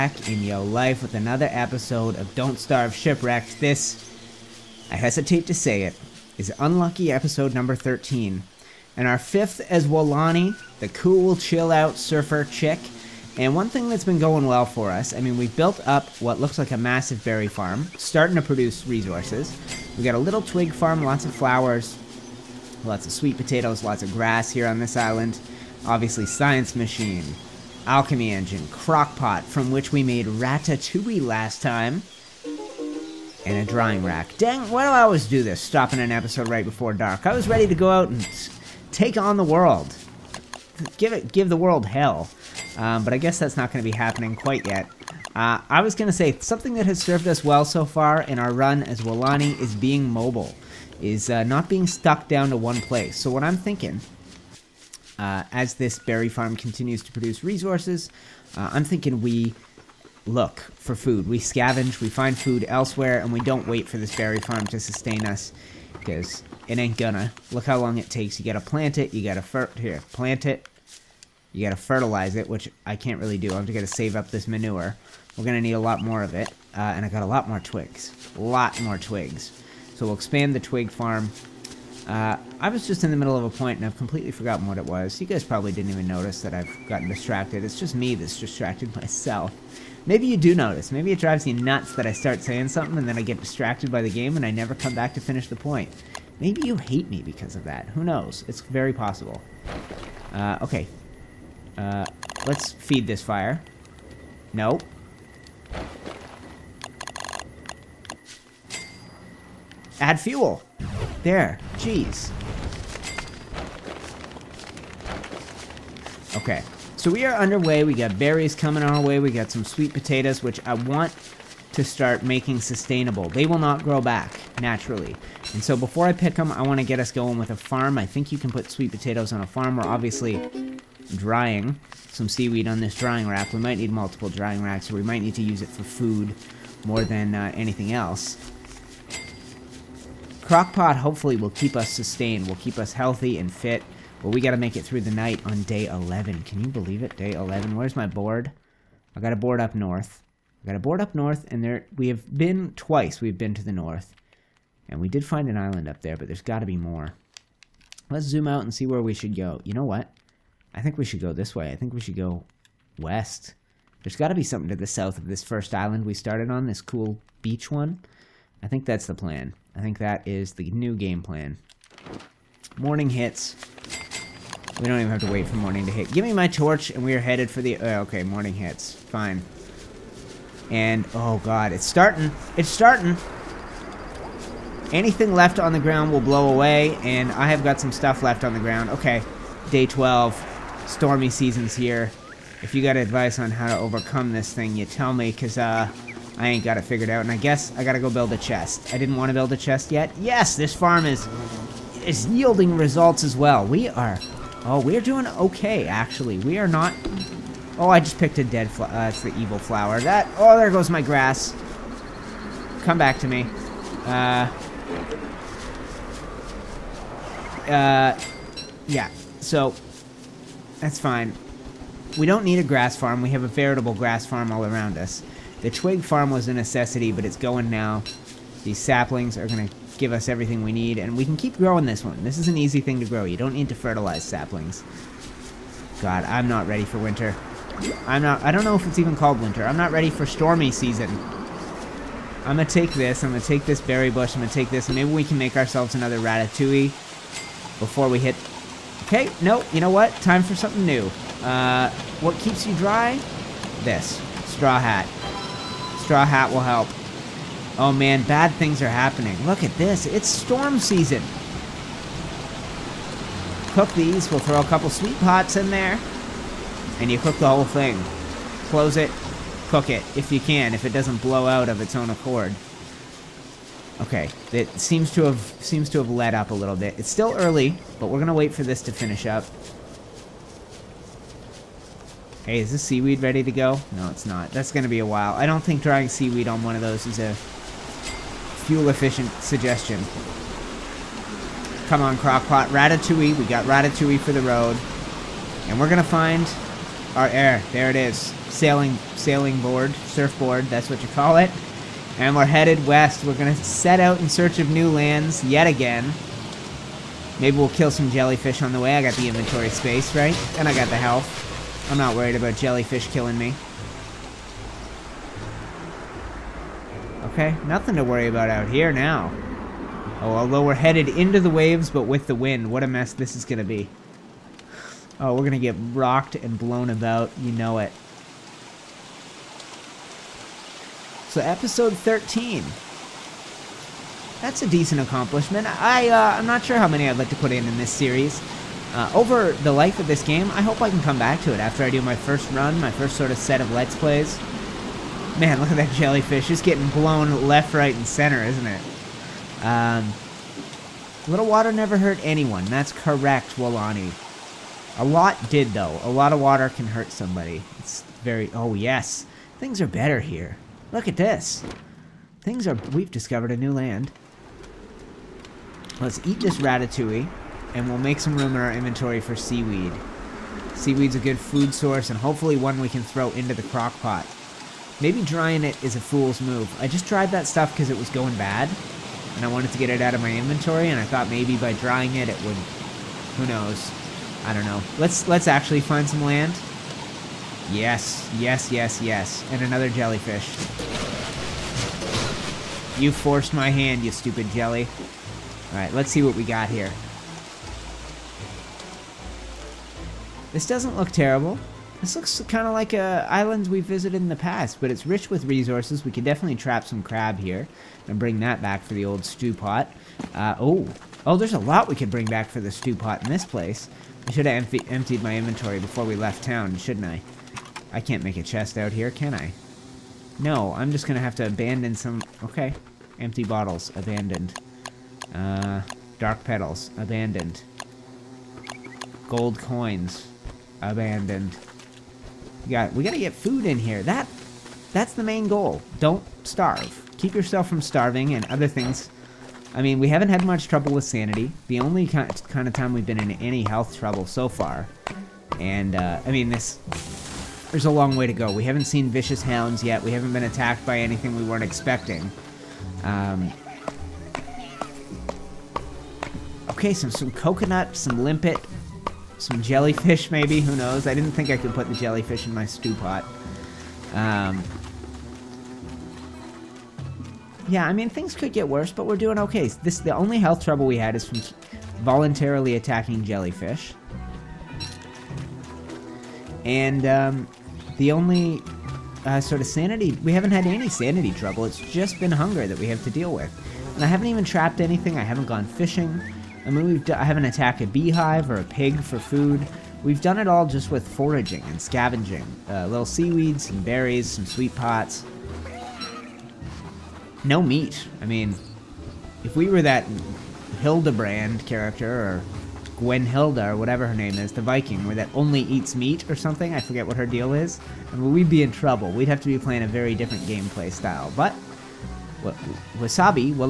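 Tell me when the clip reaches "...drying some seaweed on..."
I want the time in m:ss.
2:11.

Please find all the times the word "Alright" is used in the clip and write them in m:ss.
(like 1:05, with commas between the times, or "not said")
6:35.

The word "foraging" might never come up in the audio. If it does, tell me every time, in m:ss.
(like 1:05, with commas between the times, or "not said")
8:11.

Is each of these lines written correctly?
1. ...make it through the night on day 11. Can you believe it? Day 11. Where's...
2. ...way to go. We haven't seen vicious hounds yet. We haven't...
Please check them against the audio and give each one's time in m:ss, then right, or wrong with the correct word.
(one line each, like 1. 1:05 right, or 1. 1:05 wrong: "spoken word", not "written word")
1. 2:24 right
2. 7:28 right.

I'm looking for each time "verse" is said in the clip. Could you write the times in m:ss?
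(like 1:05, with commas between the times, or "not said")
not said.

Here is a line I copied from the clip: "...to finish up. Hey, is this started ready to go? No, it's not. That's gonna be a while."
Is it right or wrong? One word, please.
wrong.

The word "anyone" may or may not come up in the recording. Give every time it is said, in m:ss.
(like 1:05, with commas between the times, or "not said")
5:52.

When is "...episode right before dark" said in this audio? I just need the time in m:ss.
0:36.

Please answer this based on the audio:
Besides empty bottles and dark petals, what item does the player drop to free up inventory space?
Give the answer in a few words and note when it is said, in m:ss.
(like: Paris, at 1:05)
Gold coins, at 7:09.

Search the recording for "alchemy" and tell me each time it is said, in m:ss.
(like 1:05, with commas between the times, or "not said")
0:27.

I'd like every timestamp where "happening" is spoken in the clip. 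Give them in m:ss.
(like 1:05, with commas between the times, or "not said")
0:43, 4:18.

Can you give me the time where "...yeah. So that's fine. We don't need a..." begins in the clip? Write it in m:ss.
3:38.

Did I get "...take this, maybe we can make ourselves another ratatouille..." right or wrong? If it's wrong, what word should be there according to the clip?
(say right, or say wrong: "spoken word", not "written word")
right.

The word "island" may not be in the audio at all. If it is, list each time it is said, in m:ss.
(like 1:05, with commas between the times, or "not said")
0:24, 2:35, 2:45, 6:43.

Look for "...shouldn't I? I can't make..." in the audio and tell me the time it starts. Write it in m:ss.
6:56.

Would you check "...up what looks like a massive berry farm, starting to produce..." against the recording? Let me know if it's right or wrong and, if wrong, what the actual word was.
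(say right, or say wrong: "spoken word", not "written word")
right.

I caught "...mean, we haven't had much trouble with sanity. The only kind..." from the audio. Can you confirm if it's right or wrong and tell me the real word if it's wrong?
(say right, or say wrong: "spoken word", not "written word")
right.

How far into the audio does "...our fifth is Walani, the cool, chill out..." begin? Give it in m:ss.
0:09.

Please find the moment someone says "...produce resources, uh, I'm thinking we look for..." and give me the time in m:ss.
0:57.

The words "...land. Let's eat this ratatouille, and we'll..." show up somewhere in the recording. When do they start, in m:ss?
6:03.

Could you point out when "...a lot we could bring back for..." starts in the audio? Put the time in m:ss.
6:51.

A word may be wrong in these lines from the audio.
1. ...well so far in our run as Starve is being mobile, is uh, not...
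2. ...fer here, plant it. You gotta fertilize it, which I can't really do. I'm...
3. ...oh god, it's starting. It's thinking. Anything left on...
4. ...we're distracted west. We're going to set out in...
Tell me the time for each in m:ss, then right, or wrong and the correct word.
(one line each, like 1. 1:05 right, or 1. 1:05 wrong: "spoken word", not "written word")
1. 0:47 wrong: "Walani", not "Starve"
2. 1:09 right
3. 3:01 wrong: "starting", not "thinking"
4. 5:02 wrong: "headed", not "distracted".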